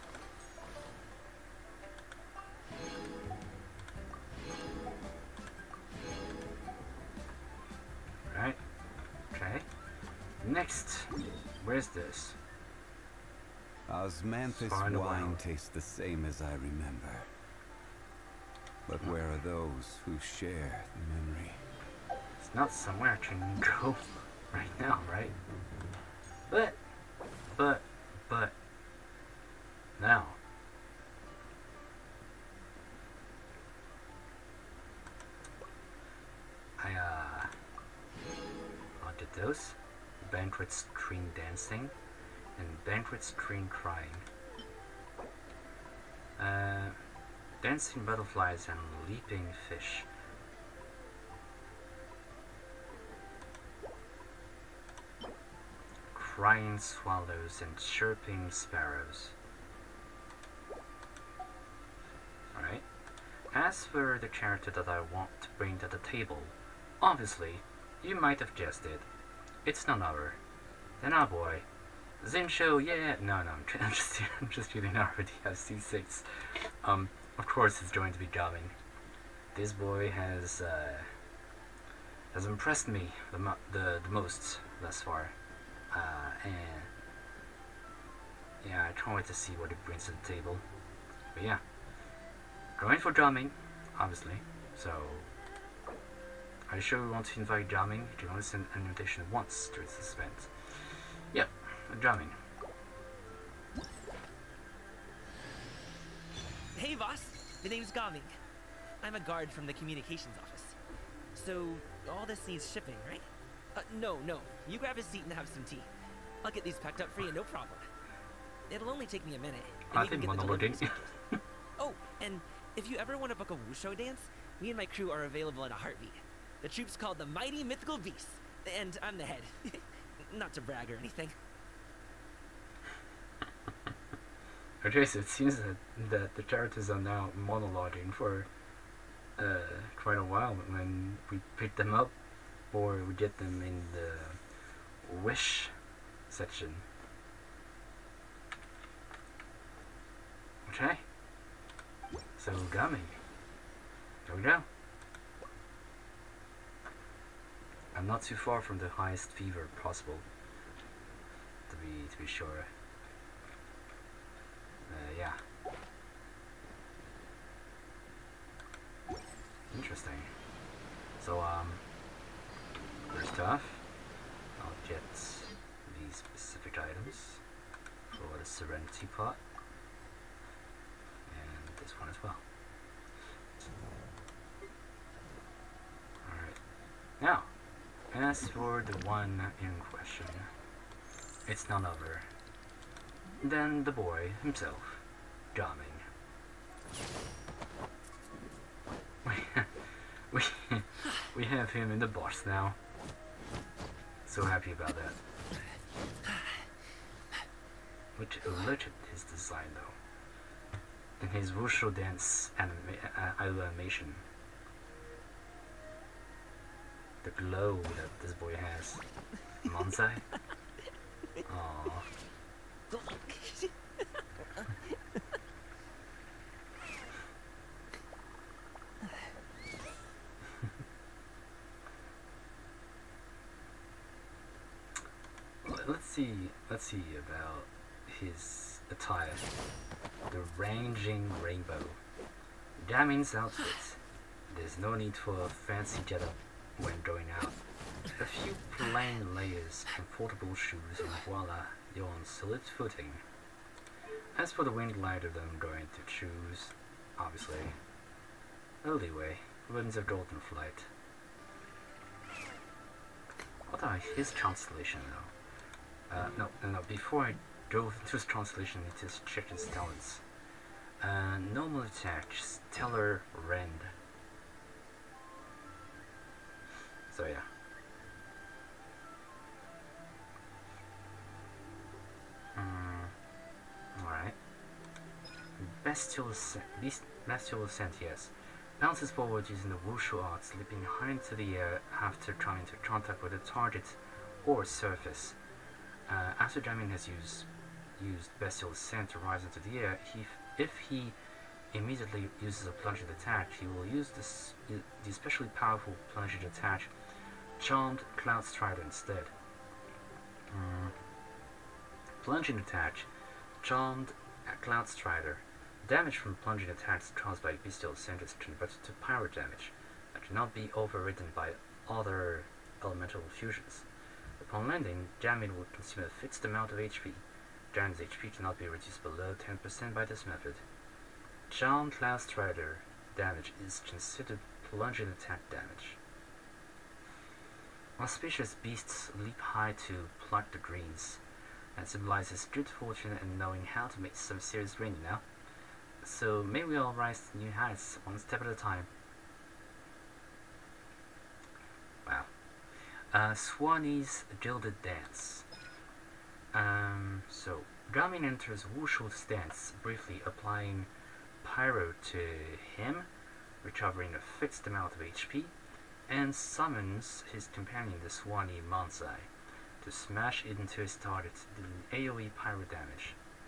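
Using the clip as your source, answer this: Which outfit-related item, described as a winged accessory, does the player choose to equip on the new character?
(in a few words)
Winds of Golden Flight.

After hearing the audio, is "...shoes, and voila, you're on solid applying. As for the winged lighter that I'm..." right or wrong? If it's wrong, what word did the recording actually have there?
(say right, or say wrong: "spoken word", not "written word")
wrong: "footing", not "applying".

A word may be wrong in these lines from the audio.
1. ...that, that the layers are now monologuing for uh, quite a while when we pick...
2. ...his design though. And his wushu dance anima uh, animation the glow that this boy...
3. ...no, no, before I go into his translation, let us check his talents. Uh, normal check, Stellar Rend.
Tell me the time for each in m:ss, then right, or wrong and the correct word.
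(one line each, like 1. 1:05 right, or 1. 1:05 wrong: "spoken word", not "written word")
1. 2:15 wrong: "characters", not "layers"
2. 3:29 right
3. 4:26 wrong: "attack", not "check".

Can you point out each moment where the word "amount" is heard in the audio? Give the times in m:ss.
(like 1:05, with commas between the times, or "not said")
5:26, 6:04.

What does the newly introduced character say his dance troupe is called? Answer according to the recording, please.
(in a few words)
Mighty Mythical Beasts.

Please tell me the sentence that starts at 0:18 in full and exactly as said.
But where are those who share the memory?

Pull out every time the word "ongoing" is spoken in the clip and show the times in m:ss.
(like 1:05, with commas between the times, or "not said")
not said.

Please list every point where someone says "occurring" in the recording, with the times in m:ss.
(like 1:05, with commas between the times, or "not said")
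not said.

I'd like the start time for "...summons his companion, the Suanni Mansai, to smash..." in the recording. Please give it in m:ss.
6:06.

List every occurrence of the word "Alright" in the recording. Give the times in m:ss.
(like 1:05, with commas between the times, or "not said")
1:02, 3:06, 4:44.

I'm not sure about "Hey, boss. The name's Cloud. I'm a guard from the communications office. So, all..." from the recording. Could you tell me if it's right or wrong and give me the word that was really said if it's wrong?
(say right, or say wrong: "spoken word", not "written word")
wrong: "Gaming", not "Cloud".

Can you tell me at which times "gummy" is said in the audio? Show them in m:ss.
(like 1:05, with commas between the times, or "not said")
2:32.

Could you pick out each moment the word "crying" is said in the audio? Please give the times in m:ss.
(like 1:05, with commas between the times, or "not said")
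0:43, 0:56.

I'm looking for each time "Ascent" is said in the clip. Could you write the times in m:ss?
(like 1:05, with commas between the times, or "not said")
4:47, 4:58, 5:17.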